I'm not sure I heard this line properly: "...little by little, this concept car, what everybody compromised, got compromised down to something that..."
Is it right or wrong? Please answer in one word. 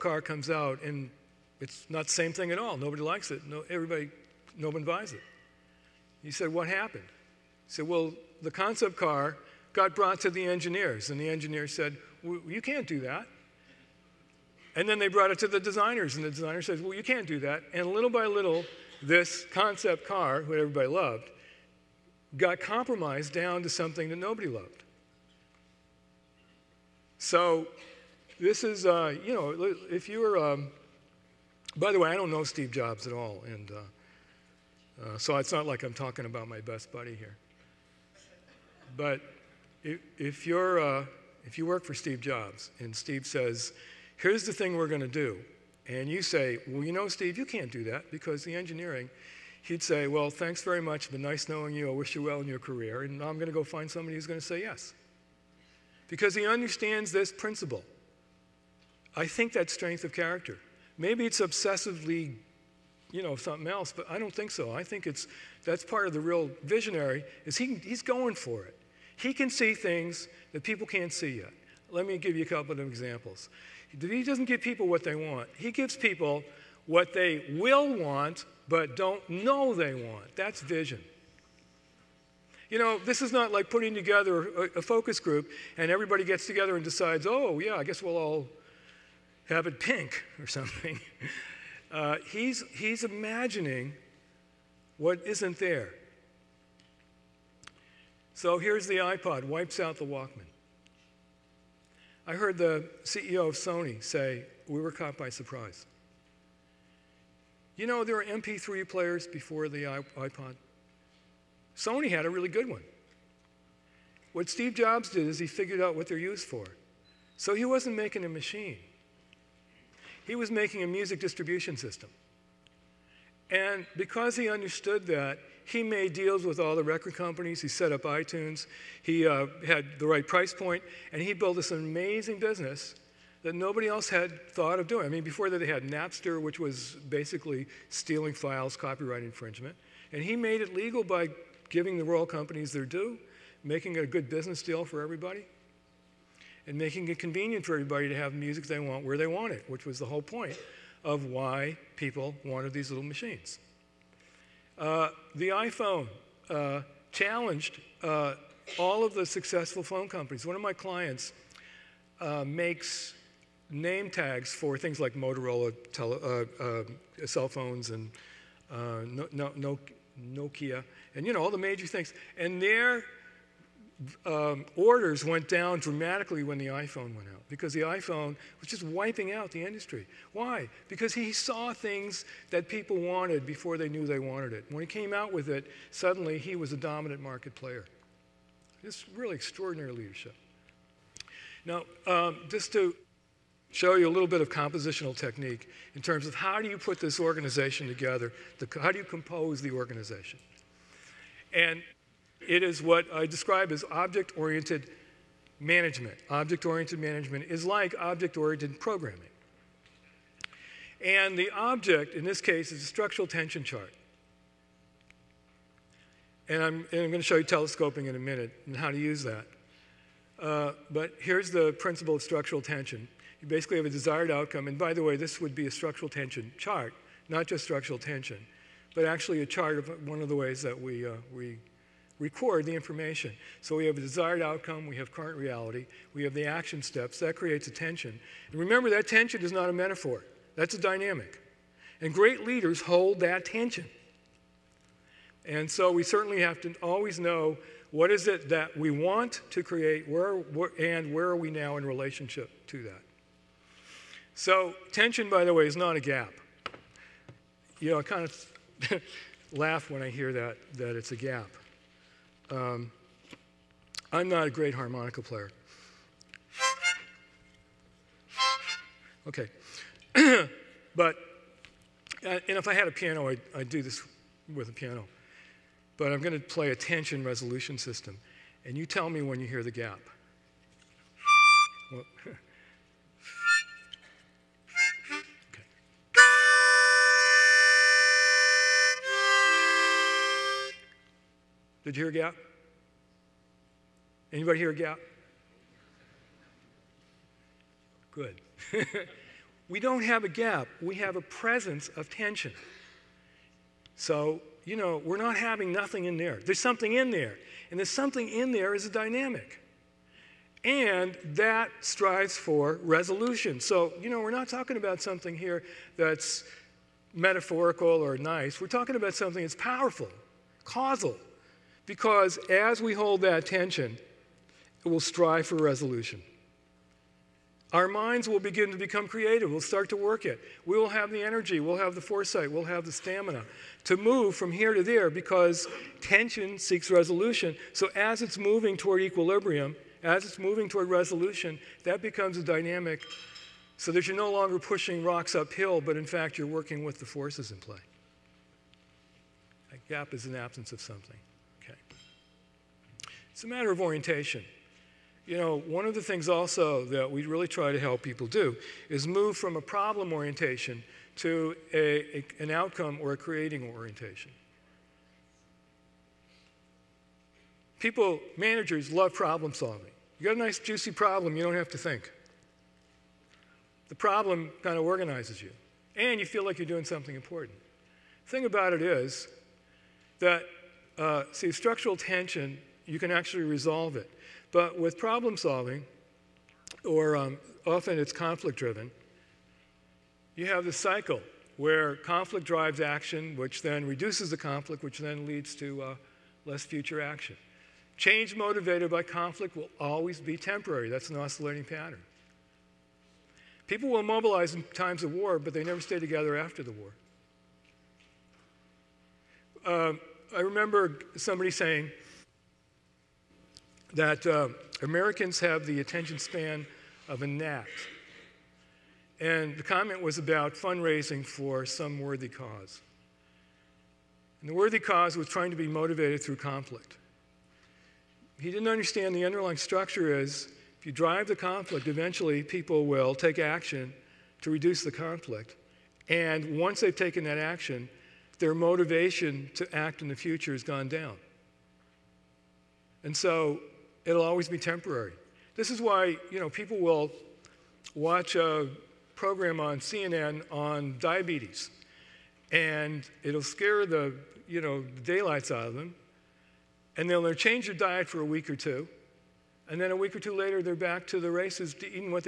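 wrong.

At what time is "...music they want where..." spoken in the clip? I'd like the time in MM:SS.
02:28.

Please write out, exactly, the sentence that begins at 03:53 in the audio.
So we have a desired outcome, we have current reality, we have the action steps.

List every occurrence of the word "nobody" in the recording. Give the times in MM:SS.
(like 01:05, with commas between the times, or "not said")
00:02, 00:24, 02:13.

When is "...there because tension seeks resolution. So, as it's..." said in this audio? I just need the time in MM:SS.
05:34.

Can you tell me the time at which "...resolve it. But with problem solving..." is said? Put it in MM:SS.
06:23.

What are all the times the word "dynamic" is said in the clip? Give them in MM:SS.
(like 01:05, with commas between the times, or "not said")
04:00, 05:08, 05:42.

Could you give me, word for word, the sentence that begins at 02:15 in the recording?
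I mean, before that, they had Napster, which was basically stealing files, copyright infringement.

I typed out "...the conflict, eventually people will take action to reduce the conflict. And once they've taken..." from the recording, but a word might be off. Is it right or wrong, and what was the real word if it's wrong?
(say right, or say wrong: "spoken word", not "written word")
right.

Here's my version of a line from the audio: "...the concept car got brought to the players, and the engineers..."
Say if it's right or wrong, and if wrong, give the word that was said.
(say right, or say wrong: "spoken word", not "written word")
wrong: "engineers", not "players".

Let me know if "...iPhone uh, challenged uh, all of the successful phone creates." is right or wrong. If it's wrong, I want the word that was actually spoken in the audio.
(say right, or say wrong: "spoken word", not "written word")
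wrong: "companies", not "creates".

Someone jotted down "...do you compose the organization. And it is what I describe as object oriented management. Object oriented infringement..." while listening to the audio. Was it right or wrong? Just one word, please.
wrong.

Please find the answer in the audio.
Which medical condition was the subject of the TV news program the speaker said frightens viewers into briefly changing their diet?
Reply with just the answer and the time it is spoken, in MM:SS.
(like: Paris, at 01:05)
diabetes, at 07:30.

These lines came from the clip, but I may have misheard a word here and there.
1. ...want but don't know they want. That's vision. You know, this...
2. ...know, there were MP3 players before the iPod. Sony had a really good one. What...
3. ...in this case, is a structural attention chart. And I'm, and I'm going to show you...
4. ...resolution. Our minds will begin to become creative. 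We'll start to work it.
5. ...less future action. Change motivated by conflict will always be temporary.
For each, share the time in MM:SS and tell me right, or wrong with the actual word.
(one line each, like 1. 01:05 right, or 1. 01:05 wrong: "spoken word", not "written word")
1. 01:17 right
2. 01:47 right
3. 03:32 wrong: "tension", not "attention"
4. 05:25 right
5. 06:36 right.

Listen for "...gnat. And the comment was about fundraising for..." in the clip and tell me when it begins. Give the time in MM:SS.
06:57.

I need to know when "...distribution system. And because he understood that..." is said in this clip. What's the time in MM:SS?
02:01.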